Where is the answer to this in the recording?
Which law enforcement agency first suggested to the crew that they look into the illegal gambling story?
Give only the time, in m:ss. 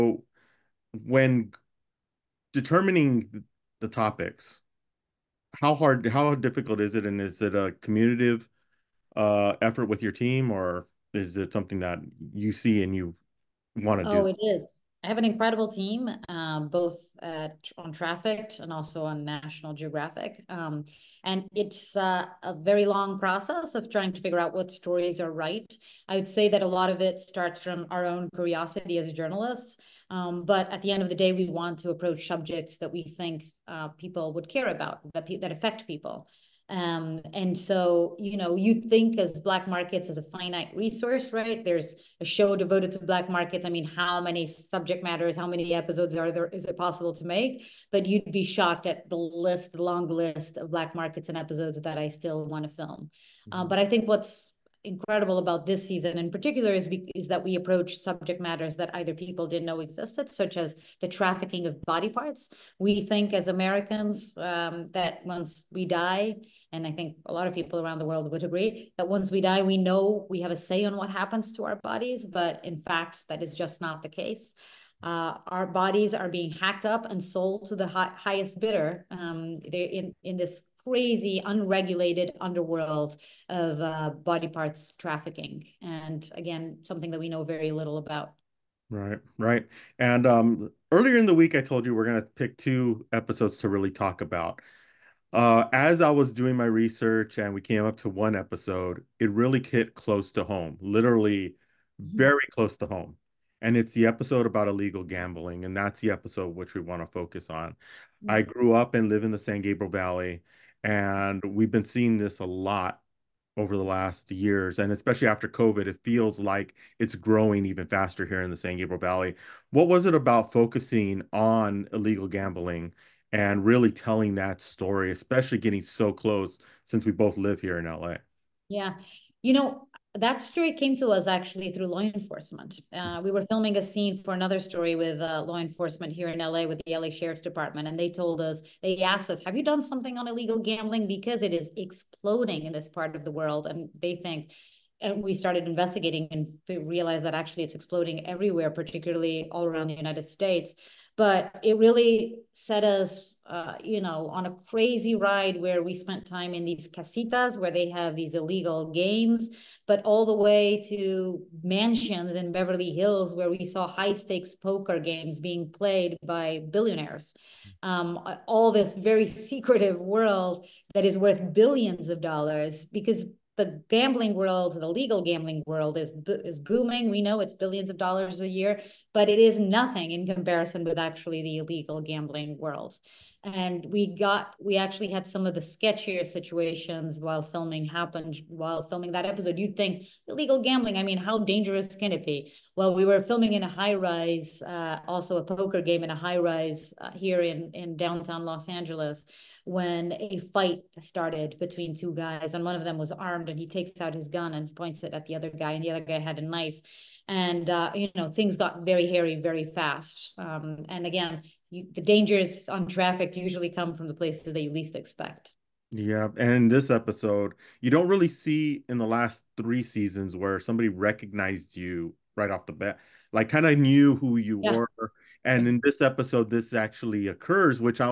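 2:16.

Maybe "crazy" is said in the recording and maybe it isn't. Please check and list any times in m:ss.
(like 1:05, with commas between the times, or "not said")
1:20, 2:34.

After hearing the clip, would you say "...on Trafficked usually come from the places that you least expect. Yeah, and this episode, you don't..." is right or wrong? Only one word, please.
right.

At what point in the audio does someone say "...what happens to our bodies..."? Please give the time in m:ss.
1:10.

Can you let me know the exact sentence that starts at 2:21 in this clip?
Because it is exploding in this part of the world.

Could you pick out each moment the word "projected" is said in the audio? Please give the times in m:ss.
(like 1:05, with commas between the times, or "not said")
not said.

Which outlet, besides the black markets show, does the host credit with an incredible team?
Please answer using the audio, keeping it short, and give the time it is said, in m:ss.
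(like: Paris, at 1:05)
National Geographic, at 0:19.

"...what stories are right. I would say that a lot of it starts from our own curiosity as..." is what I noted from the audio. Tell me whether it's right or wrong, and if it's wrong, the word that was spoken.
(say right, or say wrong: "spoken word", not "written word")
right.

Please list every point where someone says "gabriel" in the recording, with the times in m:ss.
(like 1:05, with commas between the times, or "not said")
1:49, 1:58.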